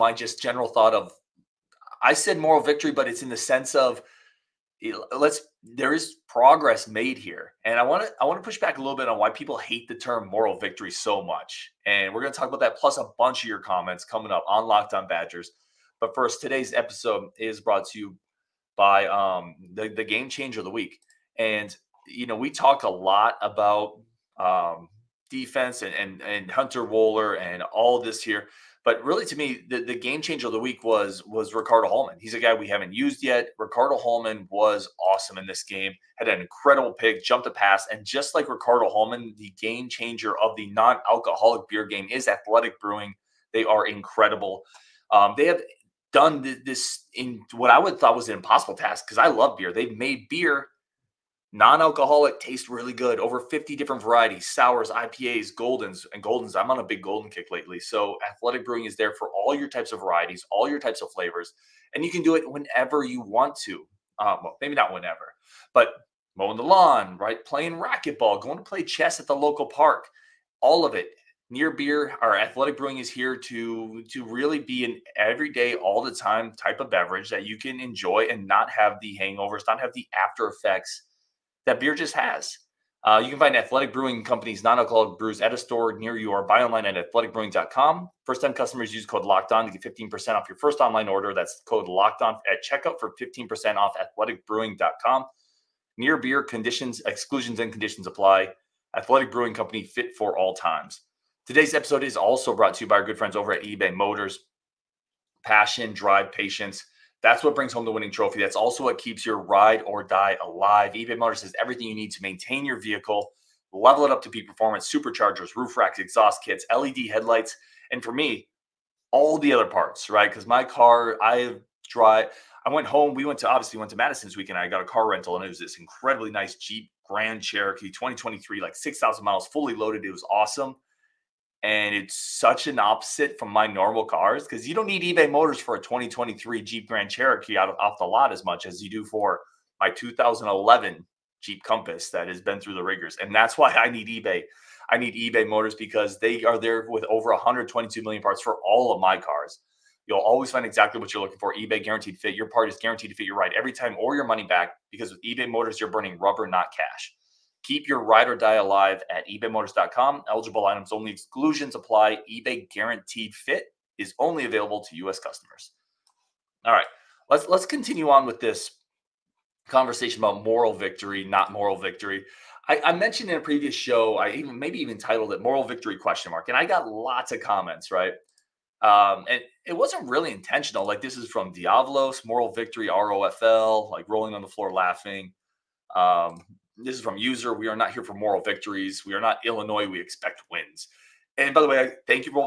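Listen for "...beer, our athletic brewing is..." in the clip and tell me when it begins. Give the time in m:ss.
1:11.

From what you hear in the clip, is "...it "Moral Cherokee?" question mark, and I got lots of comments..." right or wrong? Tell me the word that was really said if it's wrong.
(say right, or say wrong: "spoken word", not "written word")
wrong: "Victory", not "Cherokee".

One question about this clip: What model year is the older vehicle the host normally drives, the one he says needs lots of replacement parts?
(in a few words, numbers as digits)
2011.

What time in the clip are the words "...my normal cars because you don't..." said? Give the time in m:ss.
2:13.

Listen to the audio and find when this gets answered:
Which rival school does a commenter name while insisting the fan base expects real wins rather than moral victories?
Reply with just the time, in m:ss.
3:09.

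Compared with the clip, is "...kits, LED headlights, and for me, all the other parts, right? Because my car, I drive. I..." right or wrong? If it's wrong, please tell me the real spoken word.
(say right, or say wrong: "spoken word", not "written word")
right.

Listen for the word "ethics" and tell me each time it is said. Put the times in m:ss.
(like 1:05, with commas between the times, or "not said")
not said.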